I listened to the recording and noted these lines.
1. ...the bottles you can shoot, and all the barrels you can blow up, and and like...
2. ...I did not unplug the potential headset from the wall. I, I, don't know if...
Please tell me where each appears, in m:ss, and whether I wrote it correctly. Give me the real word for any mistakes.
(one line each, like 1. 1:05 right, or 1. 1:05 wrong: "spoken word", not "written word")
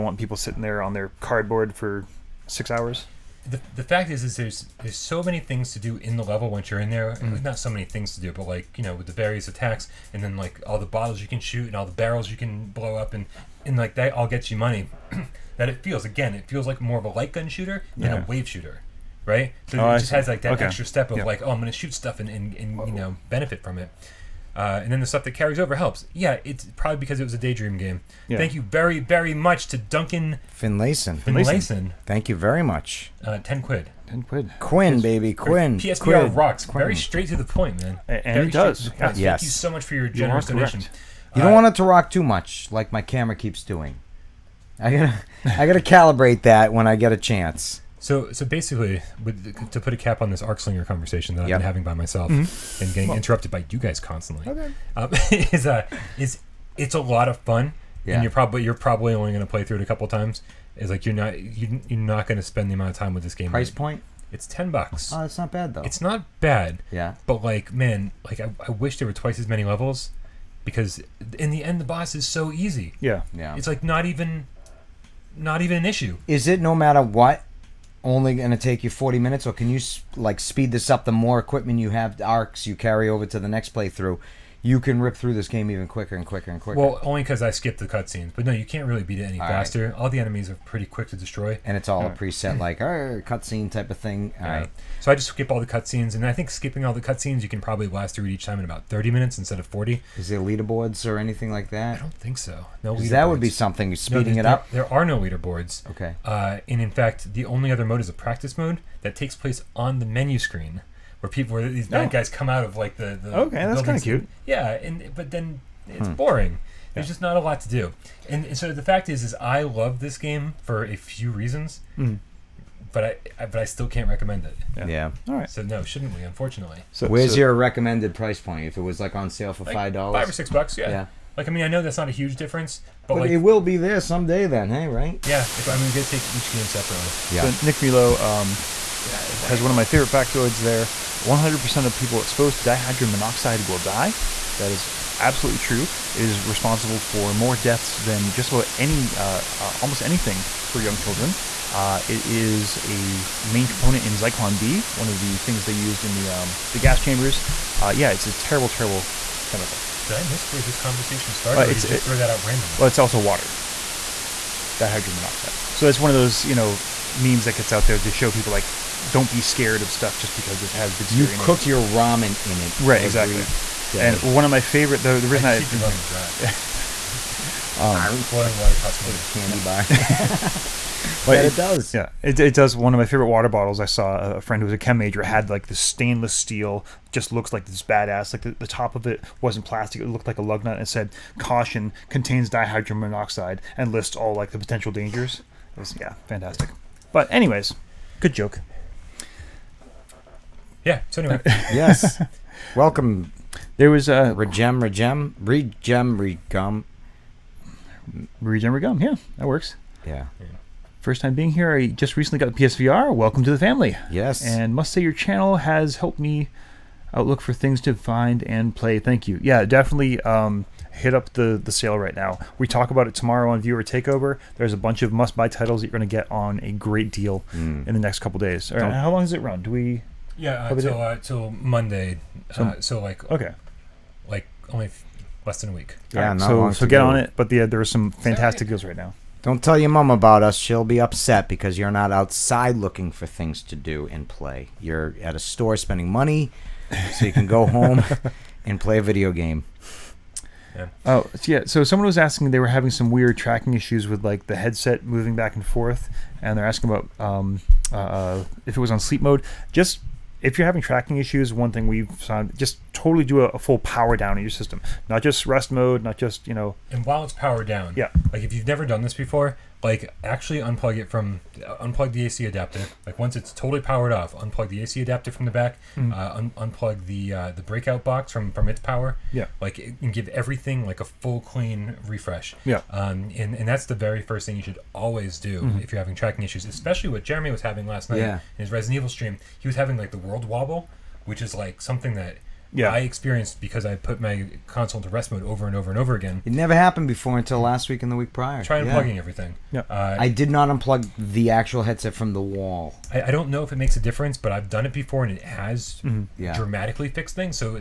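1. 0:10 right
2. 5:00 wrong: "actual", not "potential".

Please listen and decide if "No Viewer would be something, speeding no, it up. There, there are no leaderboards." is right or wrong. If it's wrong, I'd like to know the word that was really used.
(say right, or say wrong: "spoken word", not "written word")
wrong: "That", not "Viewer".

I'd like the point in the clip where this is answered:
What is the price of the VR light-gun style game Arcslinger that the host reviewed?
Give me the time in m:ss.
1:04.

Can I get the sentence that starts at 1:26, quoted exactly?
Well, only because I skipped the cutscenes.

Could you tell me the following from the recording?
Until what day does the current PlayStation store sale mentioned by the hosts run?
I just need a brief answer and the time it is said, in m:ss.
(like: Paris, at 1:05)
Monday, at 3:51.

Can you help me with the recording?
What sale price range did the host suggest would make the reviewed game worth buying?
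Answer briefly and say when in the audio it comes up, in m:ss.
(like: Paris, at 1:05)
$5 or $6, at 2:10.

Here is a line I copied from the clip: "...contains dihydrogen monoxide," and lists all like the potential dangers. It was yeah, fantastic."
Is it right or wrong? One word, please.
right.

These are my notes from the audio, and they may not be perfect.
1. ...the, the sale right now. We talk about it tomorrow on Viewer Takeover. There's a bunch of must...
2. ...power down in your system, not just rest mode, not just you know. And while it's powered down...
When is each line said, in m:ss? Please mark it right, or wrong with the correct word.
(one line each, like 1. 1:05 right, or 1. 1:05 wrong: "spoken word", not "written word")
1. 3:41 right
2. 4:23 right.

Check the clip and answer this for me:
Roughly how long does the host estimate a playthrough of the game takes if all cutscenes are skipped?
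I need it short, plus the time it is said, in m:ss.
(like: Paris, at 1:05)
30 minutes, at 1:38.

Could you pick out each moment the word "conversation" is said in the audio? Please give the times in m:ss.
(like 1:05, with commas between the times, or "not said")
0:50, 2:40.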